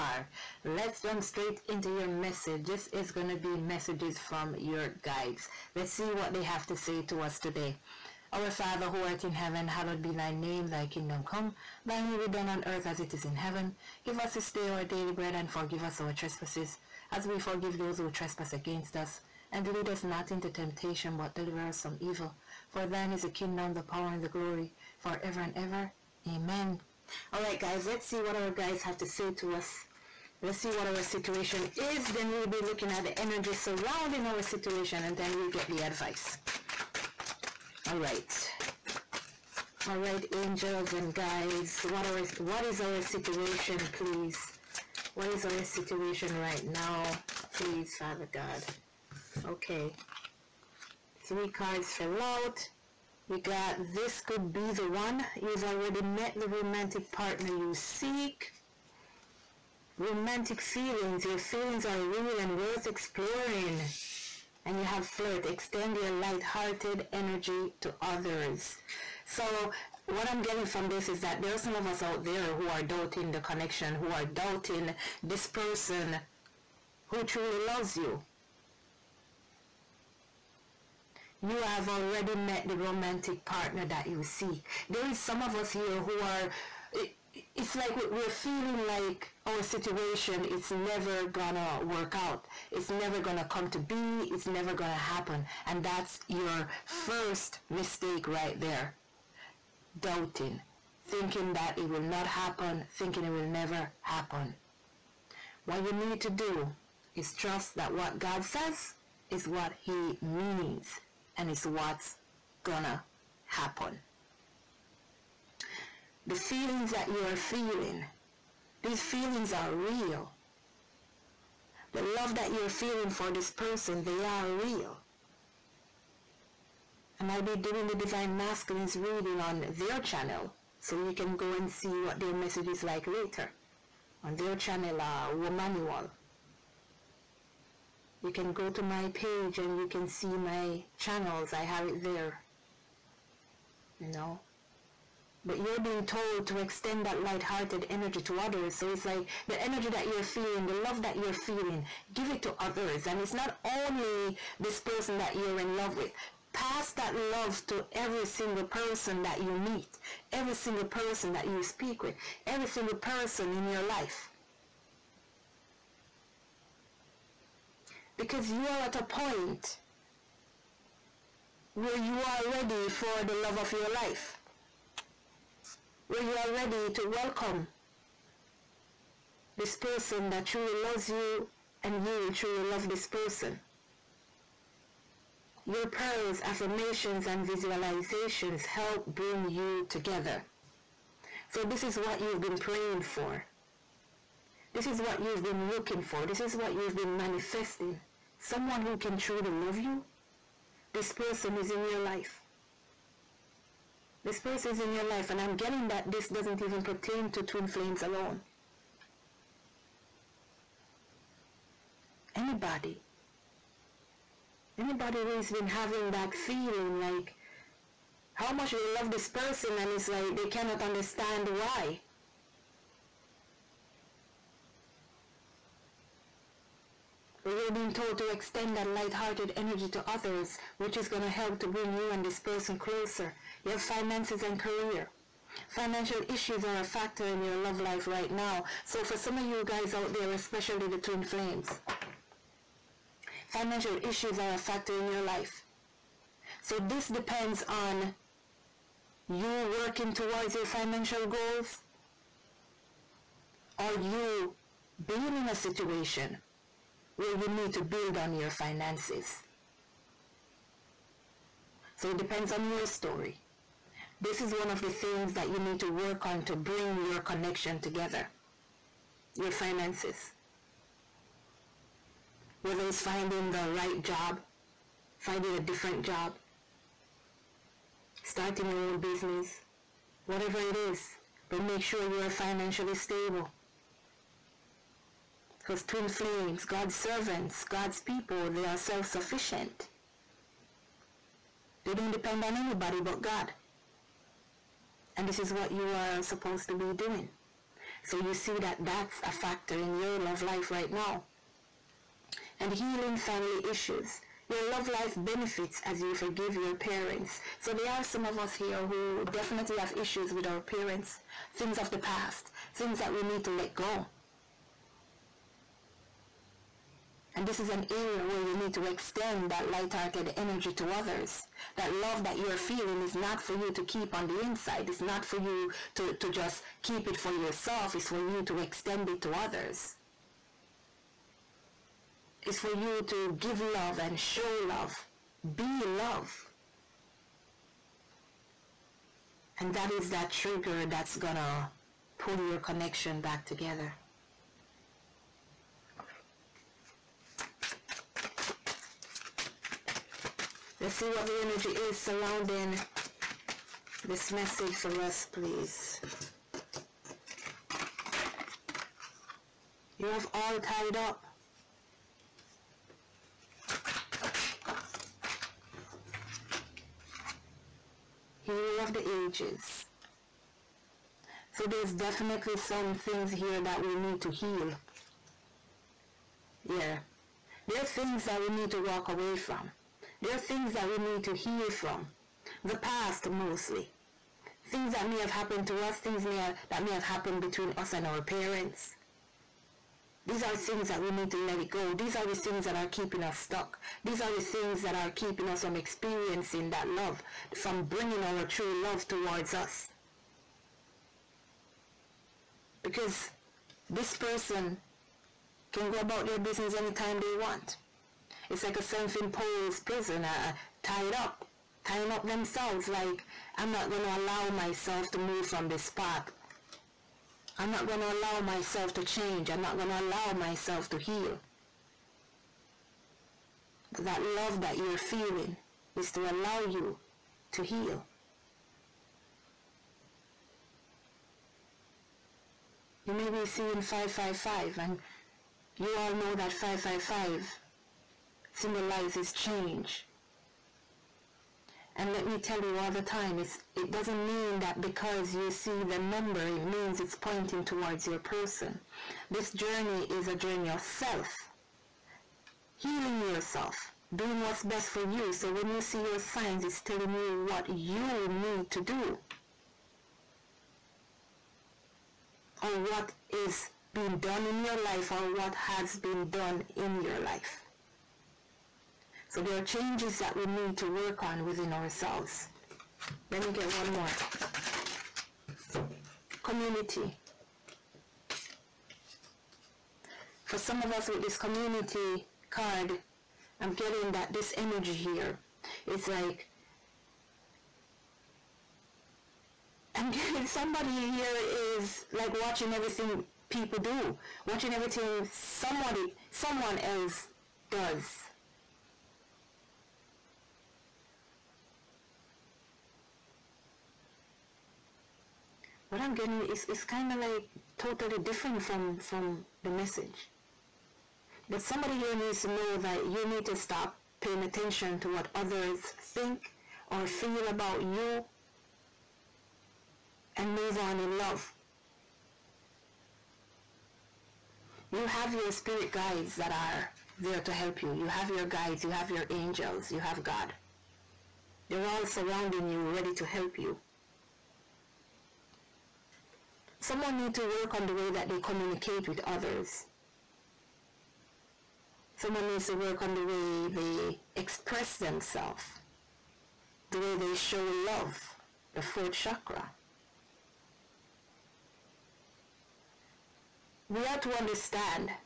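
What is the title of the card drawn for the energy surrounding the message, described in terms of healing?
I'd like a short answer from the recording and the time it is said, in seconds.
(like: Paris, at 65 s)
Healer of the ages, at 368 s.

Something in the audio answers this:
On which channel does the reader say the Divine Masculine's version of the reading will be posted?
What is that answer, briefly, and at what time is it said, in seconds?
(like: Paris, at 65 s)
Womanual, at 135 s.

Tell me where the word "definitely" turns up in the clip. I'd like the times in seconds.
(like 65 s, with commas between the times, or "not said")
309 s, 371 s.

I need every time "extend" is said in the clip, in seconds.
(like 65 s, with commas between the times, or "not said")
65 s, 146 s, 228 s, 318 s, 328 s.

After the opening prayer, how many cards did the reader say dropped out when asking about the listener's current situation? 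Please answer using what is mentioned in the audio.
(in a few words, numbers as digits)
3.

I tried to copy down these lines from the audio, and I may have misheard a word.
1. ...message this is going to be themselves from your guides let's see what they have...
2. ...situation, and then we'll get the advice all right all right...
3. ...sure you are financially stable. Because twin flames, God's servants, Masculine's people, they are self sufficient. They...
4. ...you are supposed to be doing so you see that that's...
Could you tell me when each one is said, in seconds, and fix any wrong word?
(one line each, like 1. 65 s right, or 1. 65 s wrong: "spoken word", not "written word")
1. 2 s wrong: "messages", not "themselves"
2. 34 s right
3. 281 s wrong: "God", not "Masculine"
4. 295 s right.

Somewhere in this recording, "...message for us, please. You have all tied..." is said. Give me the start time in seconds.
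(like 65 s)
354 s.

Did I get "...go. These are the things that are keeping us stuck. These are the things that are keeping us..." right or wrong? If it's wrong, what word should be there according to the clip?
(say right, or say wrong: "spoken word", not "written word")
right.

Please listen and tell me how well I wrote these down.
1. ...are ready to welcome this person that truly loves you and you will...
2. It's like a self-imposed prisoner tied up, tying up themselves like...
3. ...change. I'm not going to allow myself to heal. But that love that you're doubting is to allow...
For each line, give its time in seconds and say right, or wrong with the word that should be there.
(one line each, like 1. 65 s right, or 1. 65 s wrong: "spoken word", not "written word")
1. 176 s right
2. 408 s right
3. 419 s wrong: "feeling", not "doubting".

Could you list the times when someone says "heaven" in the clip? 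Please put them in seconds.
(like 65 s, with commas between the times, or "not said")
9 s, 13 s.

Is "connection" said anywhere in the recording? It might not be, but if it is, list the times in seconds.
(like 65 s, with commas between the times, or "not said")
73 s, 267 s, 342 s.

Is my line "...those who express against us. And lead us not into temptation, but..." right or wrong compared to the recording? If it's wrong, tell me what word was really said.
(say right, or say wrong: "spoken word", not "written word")
wrong: "trespass", not "express".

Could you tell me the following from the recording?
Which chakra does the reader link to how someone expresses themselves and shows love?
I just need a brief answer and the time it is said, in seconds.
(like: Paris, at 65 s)
Fourth chakra, at 548 s.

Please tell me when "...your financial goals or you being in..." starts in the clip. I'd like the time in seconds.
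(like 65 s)
250 s.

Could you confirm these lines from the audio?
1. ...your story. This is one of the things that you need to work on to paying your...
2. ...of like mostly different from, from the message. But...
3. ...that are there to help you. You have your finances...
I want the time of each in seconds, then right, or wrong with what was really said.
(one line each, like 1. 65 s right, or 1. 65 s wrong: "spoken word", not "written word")
1. 262 s wrong: "bring", not "paying"
2. 507 s wrong: "totally", not "mostly"
3. 526 s wrong: "guides", not "finances".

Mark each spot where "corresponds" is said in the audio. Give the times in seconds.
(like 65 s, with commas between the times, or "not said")
not said.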